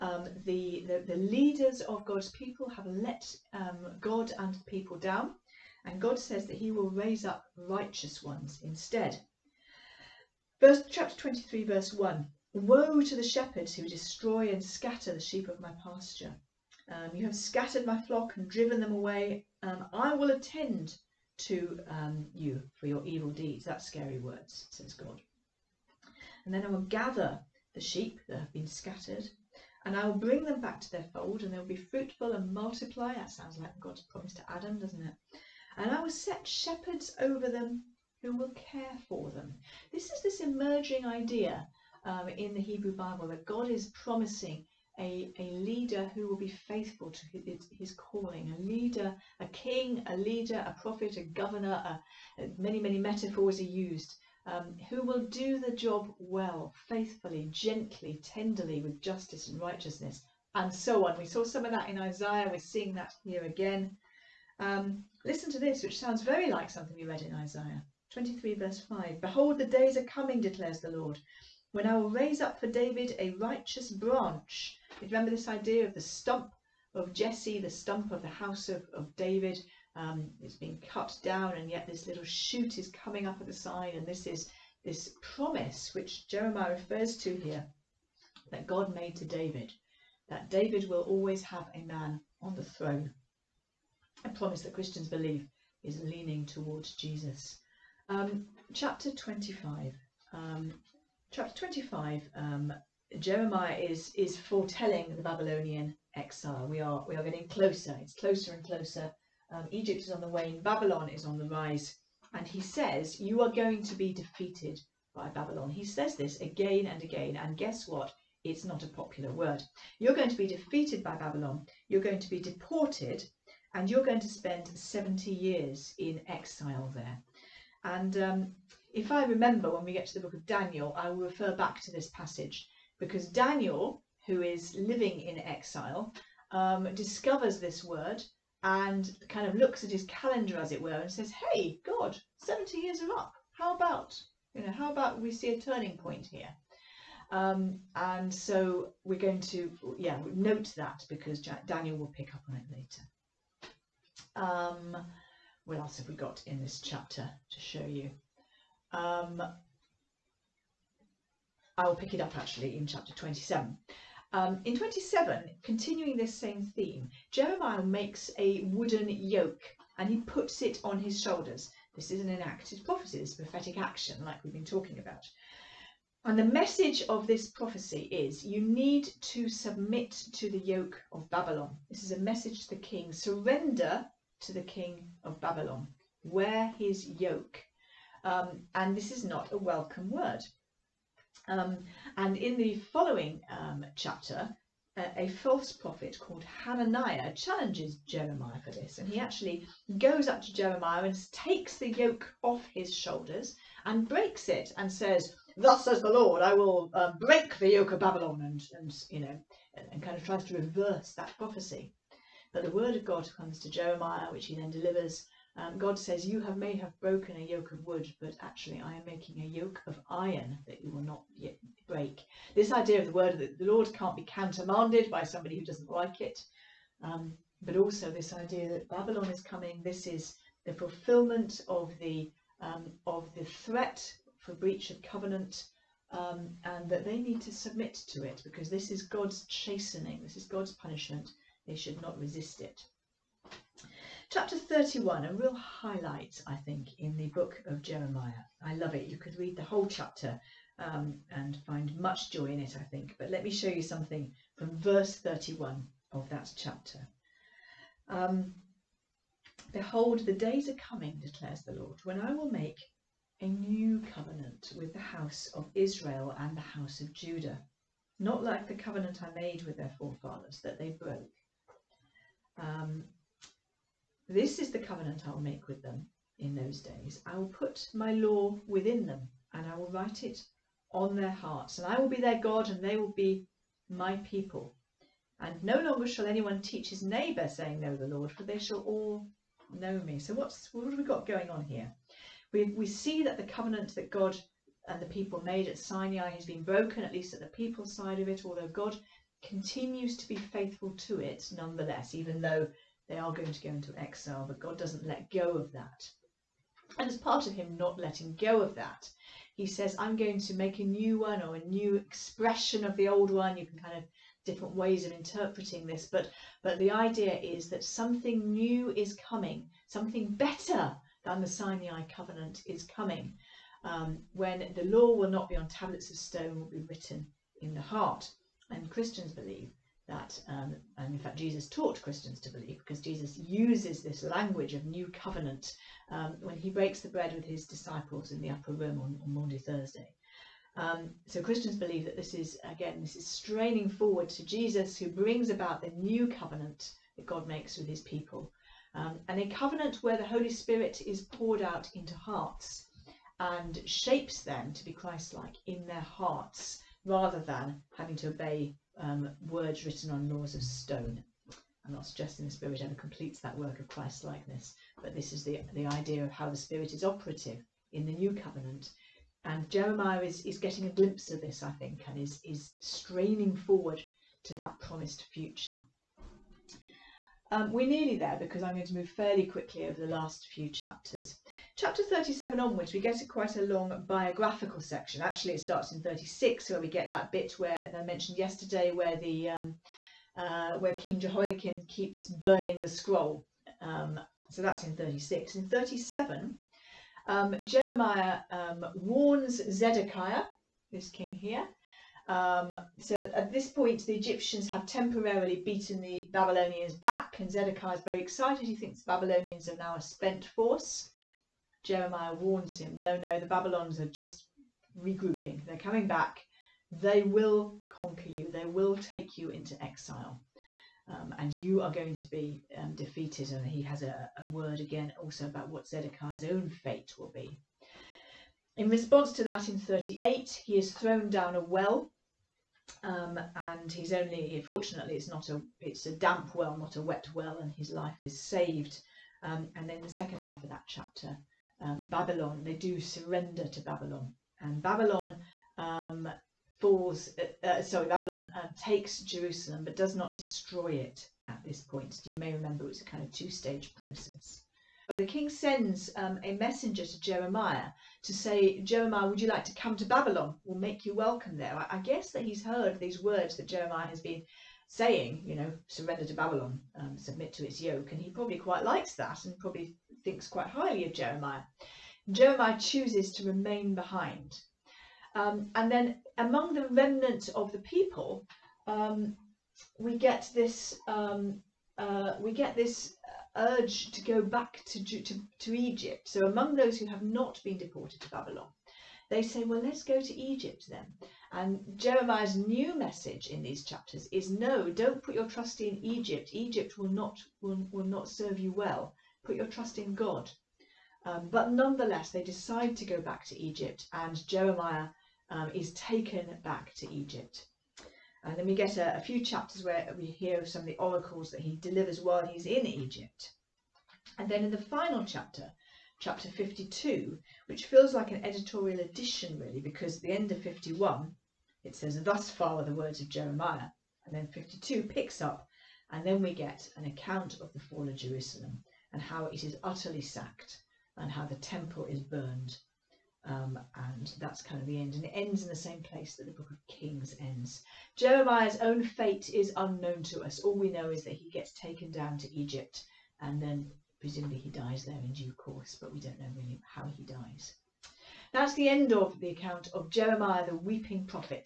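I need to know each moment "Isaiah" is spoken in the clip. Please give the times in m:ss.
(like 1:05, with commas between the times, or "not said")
1:01, 1:07.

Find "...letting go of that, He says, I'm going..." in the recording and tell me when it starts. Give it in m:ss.
5:08.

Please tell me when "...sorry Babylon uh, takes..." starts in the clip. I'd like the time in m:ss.
7:27.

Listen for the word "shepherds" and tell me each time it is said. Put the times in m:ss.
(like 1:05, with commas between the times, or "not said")
0:13, 0:36.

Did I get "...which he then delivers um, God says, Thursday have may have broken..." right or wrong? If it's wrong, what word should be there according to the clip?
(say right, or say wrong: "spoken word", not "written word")
wrong: "You", not "Thursday".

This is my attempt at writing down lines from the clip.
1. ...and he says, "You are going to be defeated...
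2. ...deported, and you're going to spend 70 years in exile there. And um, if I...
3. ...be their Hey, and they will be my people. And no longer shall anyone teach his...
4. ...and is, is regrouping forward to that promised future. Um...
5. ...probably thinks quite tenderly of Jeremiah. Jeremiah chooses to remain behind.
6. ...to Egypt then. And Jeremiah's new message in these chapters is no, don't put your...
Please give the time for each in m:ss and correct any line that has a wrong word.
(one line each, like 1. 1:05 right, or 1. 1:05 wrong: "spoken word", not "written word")
1. 1:52 right
2. 2:02 right
3. 4:42 wrong: "God", not "Hey"
4. 6:12 wrong: "straining", not "regrouping"
5. 7:49 wrong: "highly", not "tenderly"
6. 8:10 right.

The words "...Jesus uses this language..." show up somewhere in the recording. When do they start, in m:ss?
5:33.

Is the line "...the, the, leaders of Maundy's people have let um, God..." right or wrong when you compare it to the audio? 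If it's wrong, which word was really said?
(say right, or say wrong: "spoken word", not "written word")
wrong: "God", not "Maundy".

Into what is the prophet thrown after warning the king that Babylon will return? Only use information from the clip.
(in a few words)
a well.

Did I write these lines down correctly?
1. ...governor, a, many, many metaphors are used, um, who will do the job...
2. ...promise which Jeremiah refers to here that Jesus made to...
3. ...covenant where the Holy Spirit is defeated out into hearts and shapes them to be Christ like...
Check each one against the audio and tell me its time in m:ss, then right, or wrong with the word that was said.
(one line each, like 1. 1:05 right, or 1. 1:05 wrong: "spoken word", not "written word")
1. 0:51 right
2. 1:25 wrong: "God", not "Jesus"
3. 5:49 wrong: "poured", not "defeated".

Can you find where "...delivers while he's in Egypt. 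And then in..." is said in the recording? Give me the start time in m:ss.
8:31.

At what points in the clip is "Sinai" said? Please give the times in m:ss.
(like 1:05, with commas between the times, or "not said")
4:55, 5:21.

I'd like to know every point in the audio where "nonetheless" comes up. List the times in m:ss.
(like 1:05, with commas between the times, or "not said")
5:01, 8:21.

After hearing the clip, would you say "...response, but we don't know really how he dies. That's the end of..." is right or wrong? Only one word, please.
wrong.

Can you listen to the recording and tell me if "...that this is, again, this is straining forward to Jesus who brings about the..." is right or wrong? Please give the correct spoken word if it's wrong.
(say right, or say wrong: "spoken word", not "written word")
right.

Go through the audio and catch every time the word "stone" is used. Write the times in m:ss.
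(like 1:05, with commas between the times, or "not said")
5:26, 6:00.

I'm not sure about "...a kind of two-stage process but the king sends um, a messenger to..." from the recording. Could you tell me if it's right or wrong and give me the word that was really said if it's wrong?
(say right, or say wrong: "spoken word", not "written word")
right.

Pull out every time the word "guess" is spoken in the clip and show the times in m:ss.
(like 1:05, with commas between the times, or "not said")
1:57, 7:41.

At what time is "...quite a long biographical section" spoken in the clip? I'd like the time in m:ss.
6:23.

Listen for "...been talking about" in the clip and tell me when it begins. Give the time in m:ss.
2:54.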